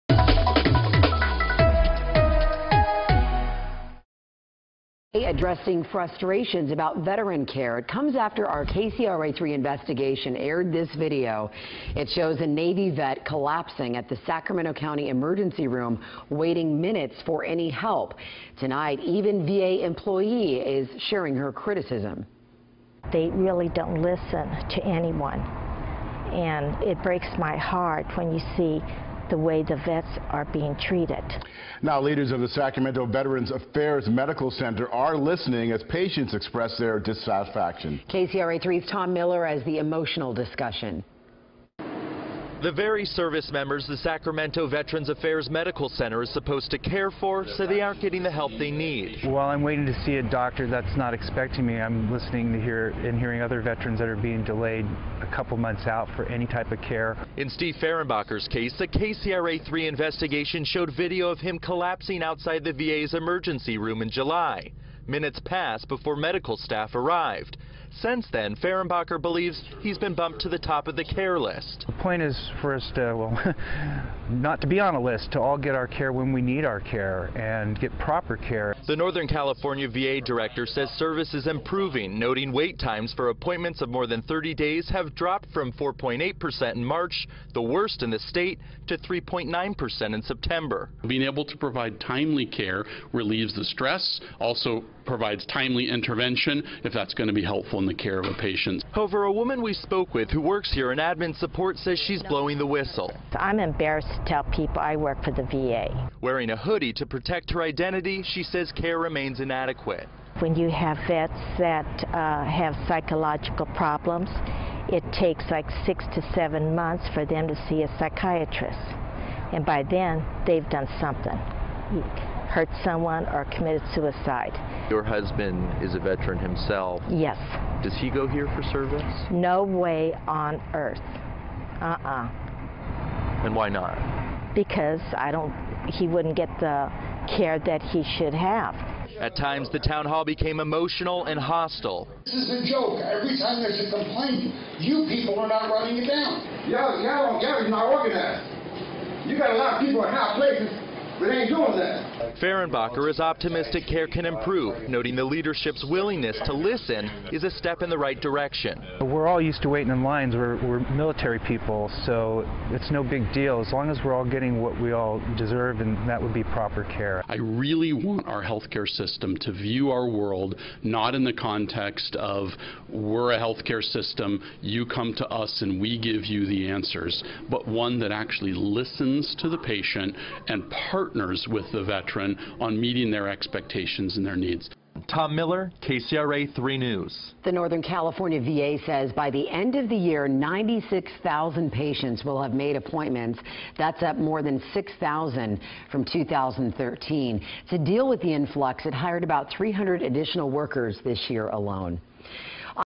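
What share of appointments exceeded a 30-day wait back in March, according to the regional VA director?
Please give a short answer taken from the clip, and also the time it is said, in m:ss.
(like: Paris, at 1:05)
4.8%, at 1:25.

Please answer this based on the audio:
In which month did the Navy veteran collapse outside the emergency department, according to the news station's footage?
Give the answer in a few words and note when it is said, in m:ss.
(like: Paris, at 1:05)
July, at 1:04.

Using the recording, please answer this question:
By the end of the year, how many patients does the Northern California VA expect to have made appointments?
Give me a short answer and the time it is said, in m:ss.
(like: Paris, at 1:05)
96,000, at 3:10.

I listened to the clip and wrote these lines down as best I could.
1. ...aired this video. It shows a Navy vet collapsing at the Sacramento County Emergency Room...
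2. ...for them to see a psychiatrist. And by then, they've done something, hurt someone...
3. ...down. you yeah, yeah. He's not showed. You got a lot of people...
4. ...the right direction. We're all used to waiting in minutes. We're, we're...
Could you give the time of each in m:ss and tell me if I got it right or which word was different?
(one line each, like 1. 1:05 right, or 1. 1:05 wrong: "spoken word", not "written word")
1. 0:10 right
2. 1:57 right
3. 2:26 wrong: "organized", not "showed"
4. 2:37 wrong: "lines", not "minutes".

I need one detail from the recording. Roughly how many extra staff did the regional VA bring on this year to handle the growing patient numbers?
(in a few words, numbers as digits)
300.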